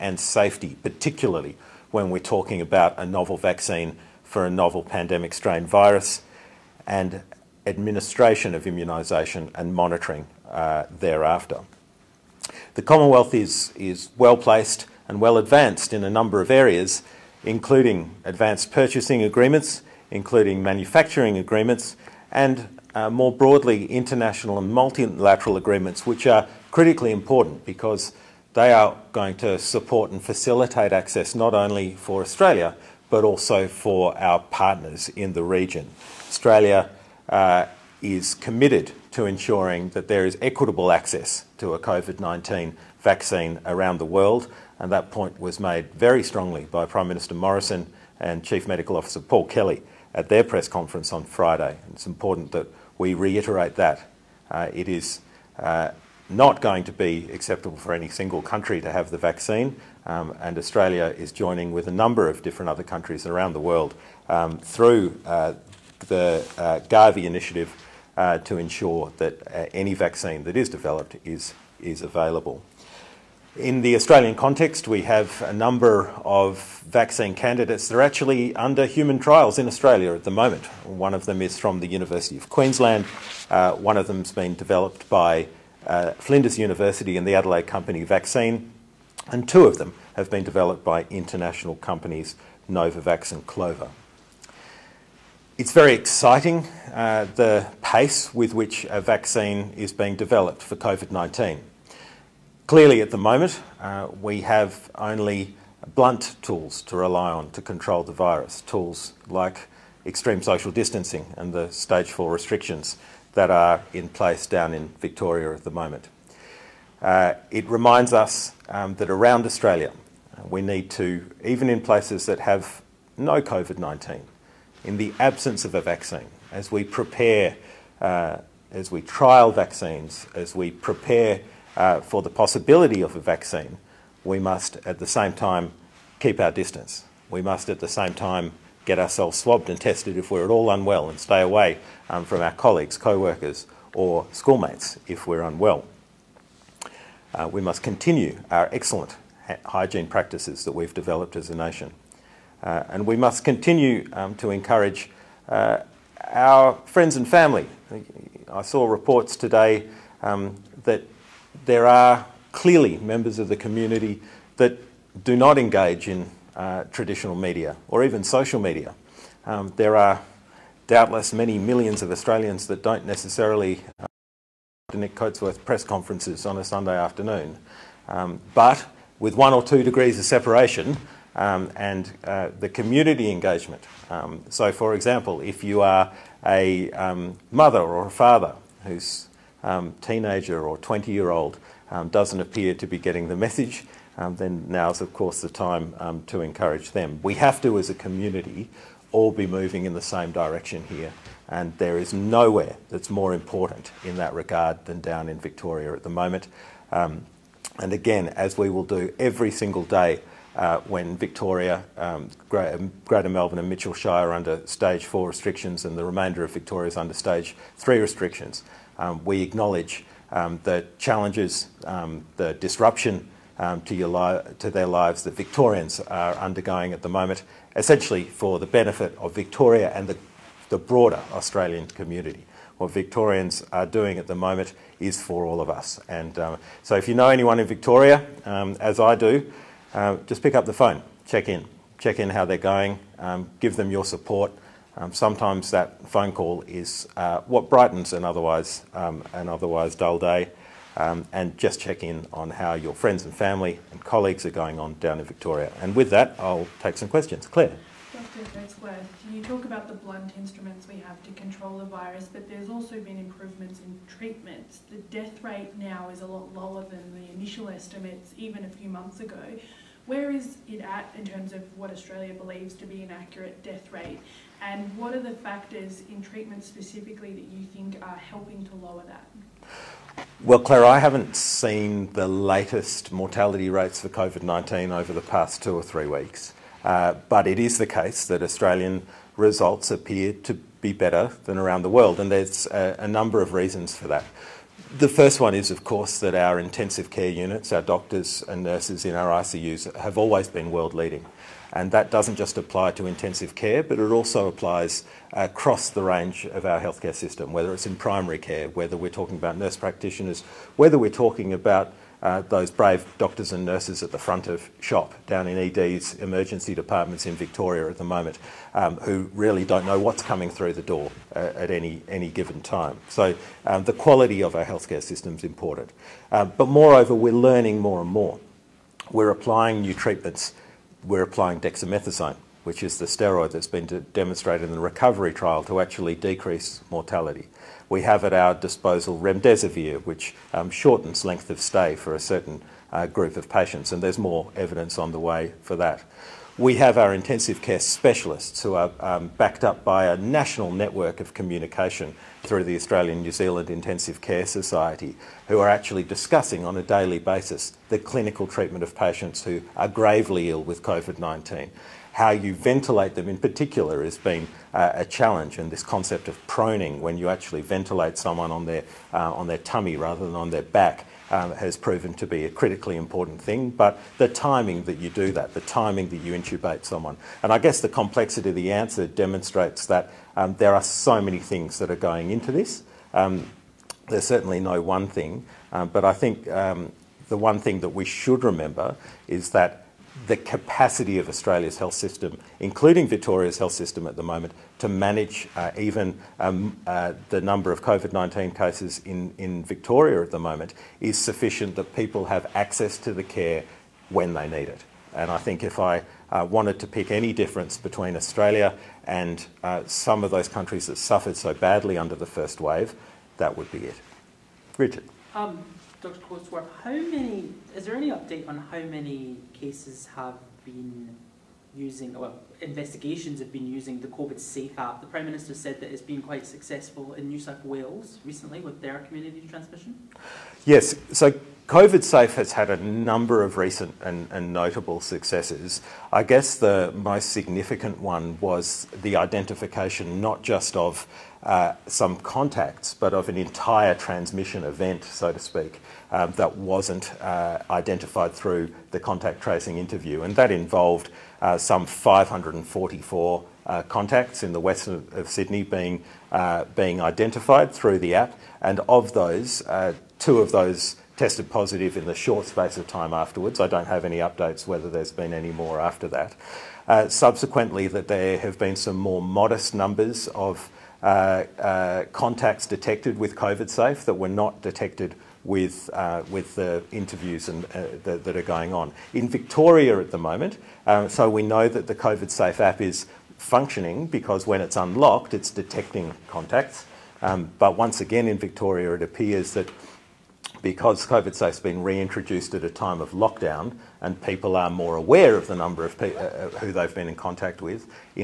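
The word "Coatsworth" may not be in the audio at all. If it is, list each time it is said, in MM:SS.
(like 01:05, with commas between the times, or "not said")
02:55, 06:56.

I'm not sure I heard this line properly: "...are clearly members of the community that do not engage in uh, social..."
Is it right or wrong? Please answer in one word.
wrong.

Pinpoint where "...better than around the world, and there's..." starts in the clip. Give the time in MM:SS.
04:50.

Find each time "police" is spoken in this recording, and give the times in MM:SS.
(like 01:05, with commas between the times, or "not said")
not said.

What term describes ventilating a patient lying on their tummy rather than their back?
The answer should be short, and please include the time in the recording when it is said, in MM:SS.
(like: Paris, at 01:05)
proning, at 06:06.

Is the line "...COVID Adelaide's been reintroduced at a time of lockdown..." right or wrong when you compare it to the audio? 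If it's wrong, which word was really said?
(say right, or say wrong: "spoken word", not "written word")
wrong: "Safe", not "Adelaide".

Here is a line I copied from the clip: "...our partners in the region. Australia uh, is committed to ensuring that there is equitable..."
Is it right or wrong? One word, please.
right.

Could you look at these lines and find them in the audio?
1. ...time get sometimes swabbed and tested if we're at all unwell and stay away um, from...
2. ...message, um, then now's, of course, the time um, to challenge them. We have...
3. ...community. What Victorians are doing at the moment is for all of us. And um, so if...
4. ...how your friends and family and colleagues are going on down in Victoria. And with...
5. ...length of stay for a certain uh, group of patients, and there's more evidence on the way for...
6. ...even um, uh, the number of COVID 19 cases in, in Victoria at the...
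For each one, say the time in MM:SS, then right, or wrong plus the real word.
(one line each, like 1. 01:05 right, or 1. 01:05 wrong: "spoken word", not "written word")
1. 02:18 wrong: "ourselves", not "sometimes"
2. 03:13 wrong: "encourage", not "challenge"
3. 03:51 right
4. 04:12 right
5. 05:41 right
6. 06:35 right.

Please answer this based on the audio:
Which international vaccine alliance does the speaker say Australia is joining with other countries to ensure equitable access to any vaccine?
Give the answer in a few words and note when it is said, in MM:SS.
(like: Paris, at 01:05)
Gavi, at 01:06.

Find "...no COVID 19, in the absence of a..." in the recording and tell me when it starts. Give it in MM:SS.
02:03.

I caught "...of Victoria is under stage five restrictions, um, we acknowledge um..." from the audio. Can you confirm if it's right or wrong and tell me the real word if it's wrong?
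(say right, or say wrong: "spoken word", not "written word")
wrong: "three", not "five".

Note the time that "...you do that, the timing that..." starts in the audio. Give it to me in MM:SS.
06:14.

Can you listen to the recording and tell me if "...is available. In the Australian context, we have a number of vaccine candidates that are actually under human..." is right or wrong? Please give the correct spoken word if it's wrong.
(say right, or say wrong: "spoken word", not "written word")
right.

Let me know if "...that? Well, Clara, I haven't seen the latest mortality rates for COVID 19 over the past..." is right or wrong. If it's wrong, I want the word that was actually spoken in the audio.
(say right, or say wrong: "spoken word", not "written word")
right.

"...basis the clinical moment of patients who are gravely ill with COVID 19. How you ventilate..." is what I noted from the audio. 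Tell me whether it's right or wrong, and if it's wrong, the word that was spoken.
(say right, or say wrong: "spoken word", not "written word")
wrong: "treatment", not "moment".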